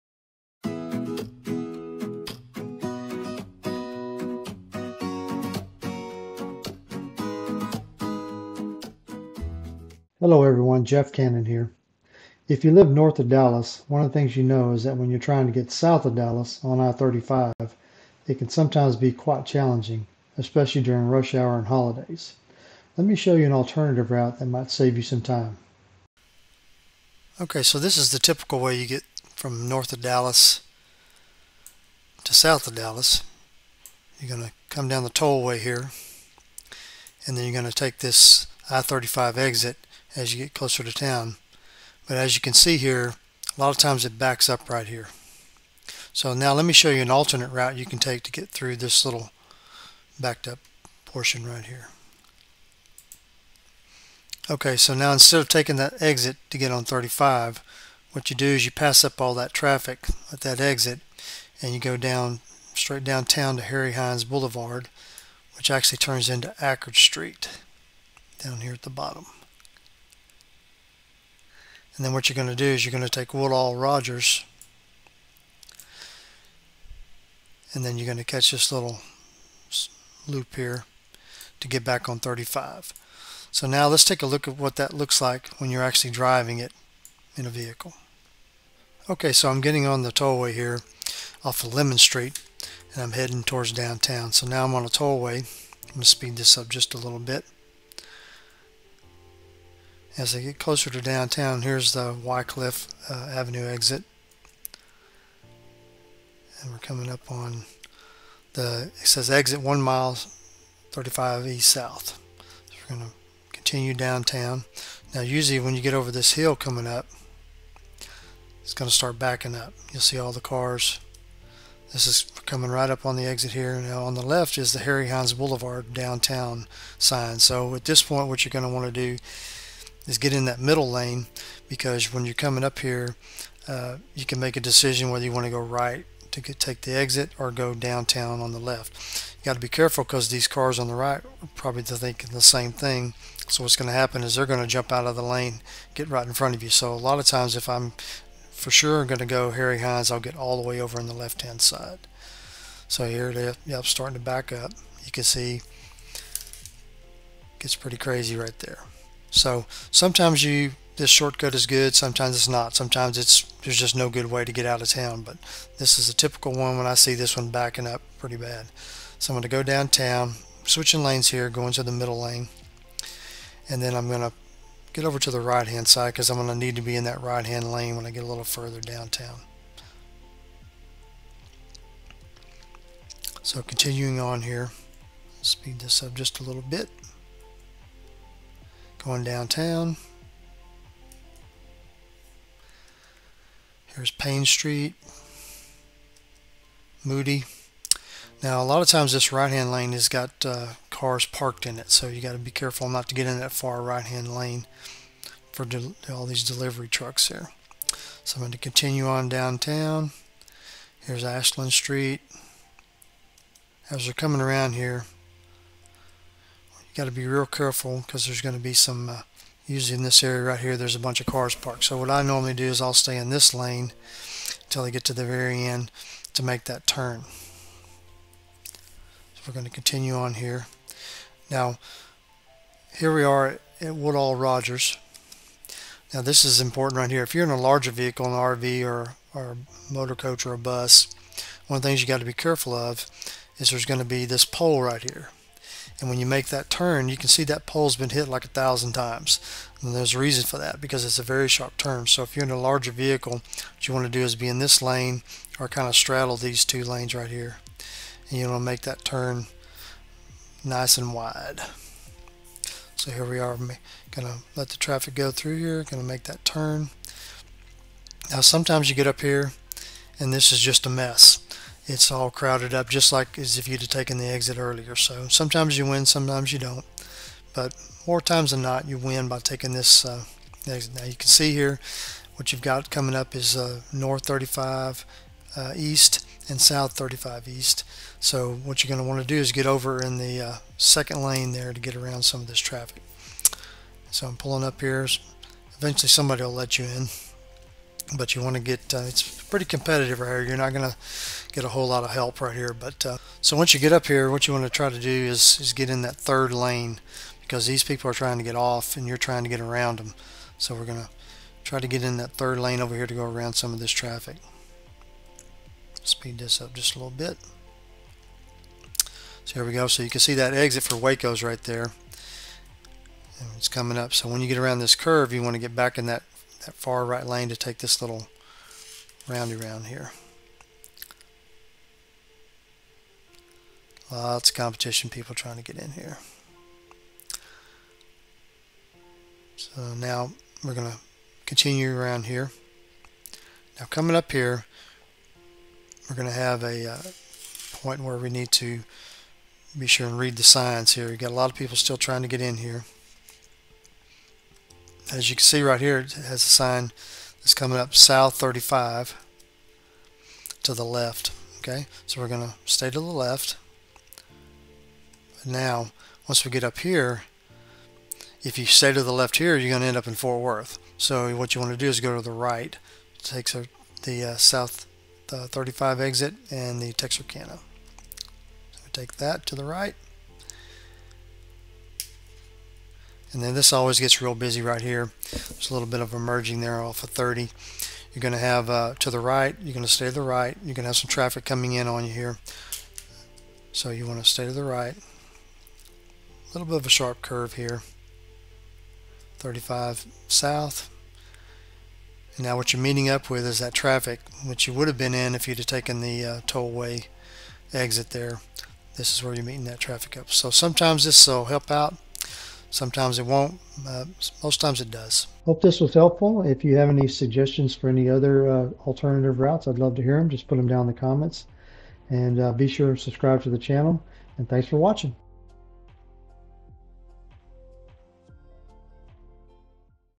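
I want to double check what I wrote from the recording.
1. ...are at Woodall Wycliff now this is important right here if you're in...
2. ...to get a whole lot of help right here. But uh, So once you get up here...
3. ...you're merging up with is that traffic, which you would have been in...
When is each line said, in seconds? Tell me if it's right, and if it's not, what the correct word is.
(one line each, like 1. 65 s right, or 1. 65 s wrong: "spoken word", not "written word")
1. 233 s wrong: "Rodgers", not "Wycliff"
2. 300 s right
3. 402 s wrong: "meeting", not "merging".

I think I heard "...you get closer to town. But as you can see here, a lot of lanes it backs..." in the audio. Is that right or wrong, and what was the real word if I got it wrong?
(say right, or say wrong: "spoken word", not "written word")
wrong: "times", not "lanes".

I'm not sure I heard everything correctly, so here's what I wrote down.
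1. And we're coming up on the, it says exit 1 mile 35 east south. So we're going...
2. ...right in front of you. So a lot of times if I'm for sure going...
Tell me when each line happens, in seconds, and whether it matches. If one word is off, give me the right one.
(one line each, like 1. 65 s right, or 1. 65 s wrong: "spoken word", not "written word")
1. 106 s right
2. 146 s right.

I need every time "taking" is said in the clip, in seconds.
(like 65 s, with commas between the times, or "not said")
55 s, 279 s.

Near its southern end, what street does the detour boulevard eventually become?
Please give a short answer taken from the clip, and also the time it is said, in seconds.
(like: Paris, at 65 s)
Akard Street, at 66 s.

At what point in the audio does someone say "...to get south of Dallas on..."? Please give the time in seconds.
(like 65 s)
15 s.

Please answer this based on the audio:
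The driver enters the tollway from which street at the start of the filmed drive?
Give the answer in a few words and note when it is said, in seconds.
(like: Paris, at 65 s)
Lemmon Street, at 91 s.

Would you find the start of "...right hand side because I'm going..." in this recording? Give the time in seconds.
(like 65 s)
175 s.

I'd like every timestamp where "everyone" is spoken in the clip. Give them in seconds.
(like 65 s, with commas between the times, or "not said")
10 s.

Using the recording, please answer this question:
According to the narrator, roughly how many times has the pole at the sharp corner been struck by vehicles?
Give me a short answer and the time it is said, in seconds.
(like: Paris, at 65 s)
1,000, at 248 s.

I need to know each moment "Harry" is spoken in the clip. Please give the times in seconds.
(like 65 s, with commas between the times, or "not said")
63 s, 124 s, 149 s.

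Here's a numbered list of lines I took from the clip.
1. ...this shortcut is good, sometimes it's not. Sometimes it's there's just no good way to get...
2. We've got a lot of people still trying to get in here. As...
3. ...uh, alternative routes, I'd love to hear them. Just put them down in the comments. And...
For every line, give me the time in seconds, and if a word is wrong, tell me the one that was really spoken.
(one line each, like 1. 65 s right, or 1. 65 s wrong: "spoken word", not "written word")
1. 160 s right
2. 351 s right
3. 418 s right.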